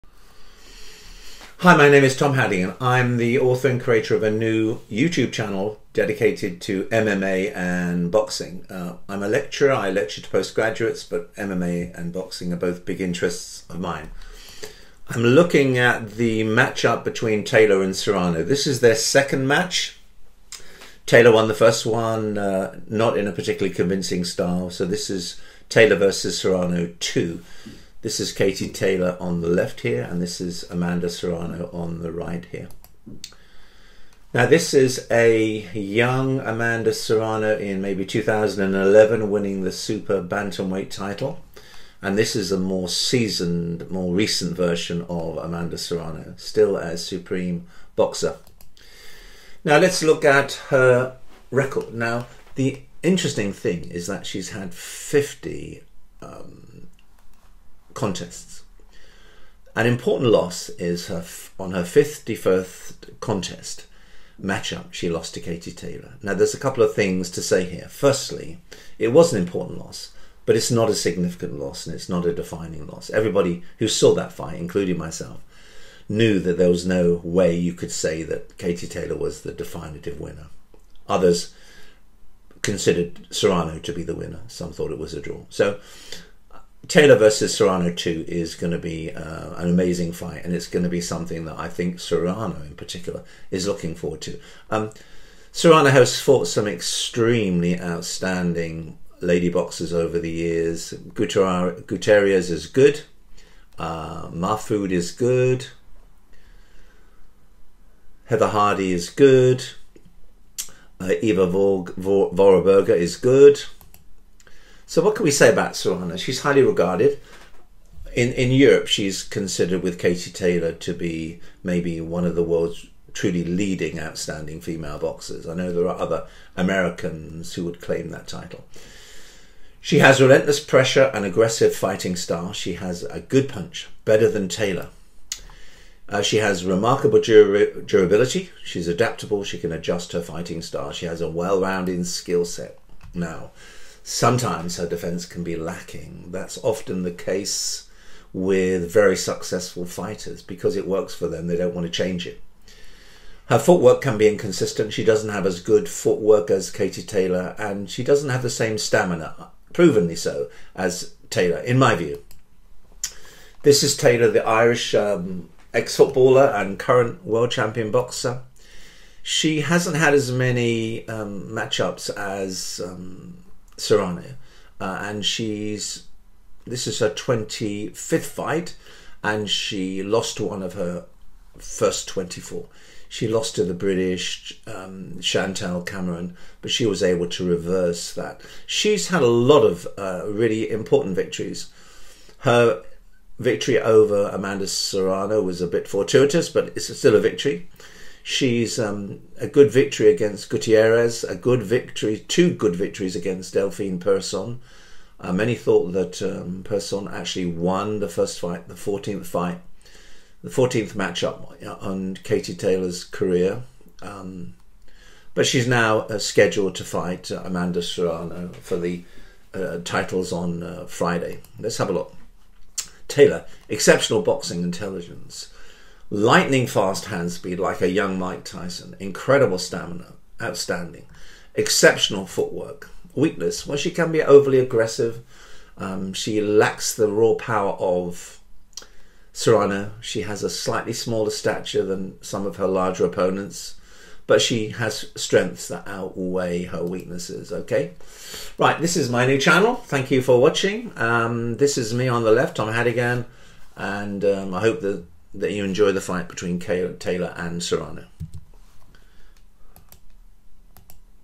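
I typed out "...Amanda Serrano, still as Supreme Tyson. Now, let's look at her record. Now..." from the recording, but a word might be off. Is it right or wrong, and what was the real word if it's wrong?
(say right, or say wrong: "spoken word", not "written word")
wrong: "Boxer", not "Tyson".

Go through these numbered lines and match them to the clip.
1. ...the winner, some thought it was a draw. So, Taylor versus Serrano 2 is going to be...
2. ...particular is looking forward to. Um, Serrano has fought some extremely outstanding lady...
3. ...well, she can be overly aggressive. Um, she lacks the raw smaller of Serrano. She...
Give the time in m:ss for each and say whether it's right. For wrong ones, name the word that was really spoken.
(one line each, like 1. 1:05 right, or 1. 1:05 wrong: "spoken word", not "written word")
1. 1:24 right
2. 1:32 right
3. 3:53 wrong: "power", not "smaller".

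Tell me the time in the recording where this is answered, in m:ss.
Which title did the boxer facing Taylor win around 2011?
0:39.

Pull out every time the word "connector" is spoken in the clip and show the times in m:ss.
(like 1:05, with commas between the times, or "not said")
not said.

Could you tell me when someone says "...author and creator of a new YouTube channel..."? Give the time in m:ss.
0:03.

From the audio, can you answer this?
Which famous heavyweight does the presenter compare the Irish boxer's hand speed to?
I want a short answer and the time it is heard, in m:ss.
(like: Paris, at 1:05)
Mike Tyson, at 3:48.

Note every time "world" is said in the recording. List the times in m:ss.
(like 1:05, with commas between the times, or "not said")
2:02, 2:47.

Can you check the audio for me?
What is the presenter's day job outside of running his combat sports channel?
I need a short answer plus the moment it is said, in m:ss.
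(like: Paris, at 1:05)
Lecturer, at 0:09.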